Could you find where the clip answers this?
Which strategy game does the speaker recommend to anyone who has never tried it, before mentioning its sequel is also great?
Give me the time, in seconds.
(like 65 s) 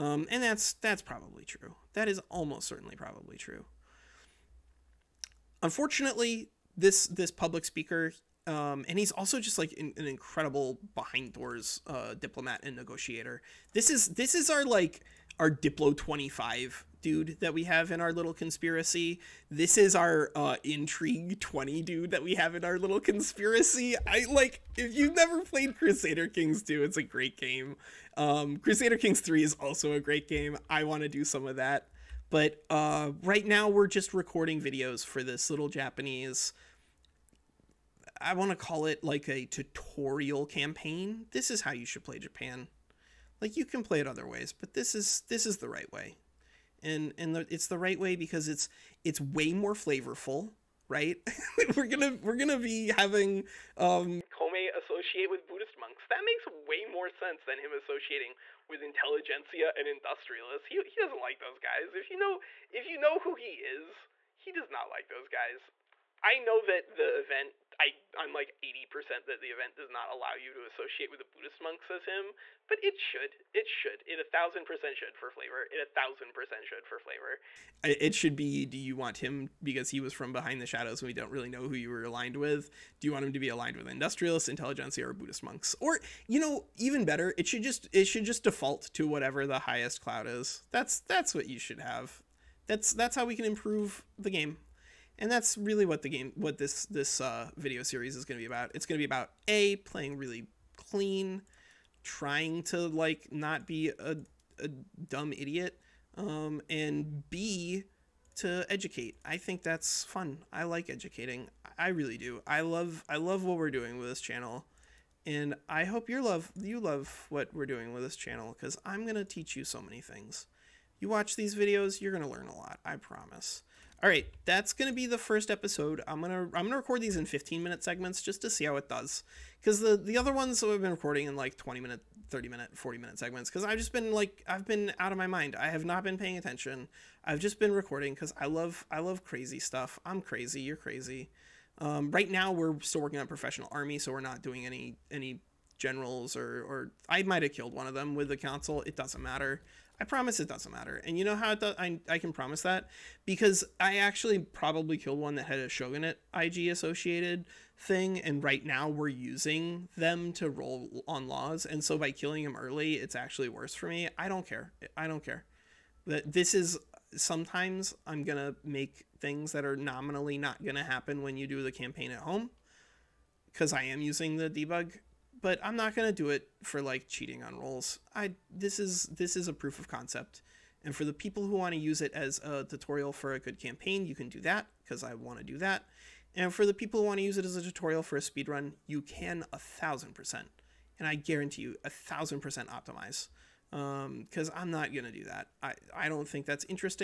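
25 s.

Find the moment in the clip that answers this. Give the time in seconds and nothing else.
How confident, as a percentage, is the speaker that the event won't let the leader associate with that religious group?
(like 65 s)
68 s.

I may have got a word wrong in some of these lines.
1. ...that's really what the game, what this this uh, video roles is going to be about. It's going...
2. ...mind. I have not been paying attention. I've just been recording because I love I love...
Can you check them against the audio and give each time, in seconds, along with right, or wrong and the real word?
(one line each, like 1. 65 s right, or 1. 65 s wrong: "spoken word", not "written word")
1. 95 s wrong: "series", not "roles"
2. 135 s right.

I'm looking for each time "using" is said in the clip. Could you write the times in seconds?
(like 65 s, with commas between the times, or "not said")
159 s, 173 s.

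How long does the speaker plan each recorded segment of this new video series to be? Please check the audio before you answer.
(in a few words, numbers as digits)
15 minutes.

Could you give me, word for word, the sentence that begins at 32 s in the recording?
But uh, right now we're just recording videos for this little Japanese I want to call it like a tutorial campaign.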